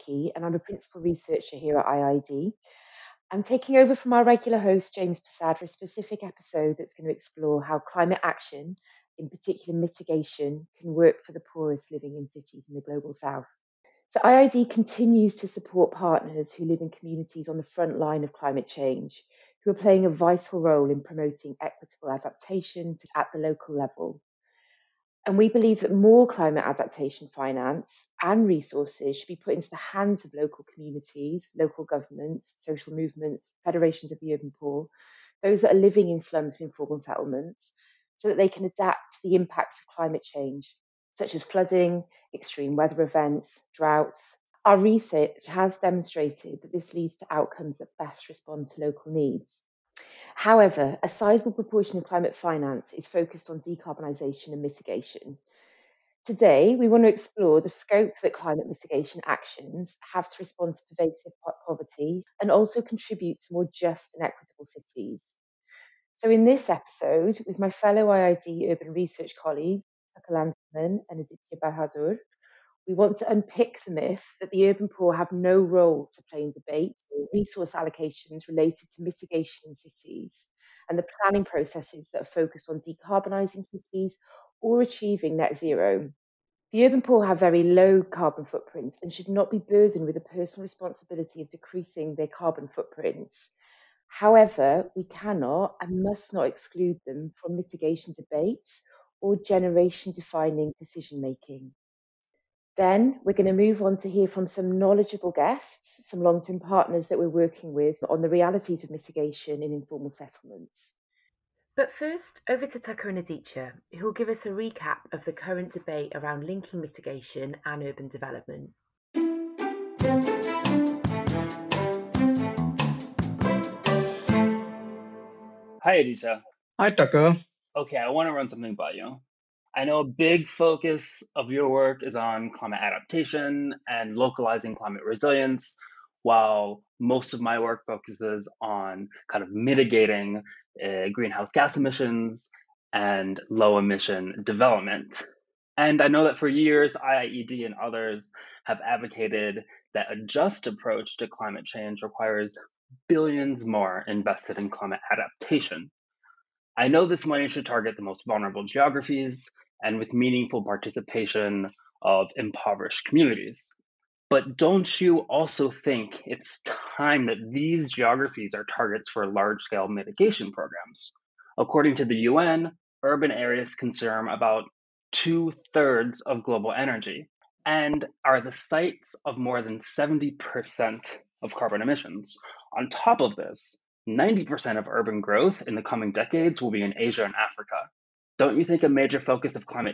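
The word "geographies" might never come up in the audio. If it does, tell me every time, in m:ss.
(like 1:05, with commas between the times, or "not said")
2:38, 2:47.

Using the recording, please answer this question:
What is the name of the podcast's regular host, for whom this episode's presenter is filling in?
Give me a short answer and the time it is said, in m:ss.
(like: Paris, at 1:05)
James Passad, at 0:04.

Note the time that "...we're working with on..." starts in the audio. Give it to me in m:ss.
1:47.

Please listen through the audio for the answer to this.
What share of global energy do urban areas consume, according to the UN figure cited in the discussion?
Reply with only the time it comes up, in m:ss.
2:55.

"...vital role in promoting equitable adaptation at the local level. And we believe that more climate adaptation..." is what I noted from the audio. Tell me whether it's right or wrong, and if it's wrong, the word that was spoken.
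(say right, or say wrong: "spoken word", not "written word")
right.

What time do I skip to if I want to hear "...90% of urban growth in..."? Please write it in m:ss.
3:04.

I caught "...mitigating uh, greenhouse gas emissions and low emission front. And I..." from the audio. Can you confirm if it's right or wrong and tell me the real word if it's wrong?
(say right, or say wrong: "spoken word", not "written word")
wrong: "development", not "front".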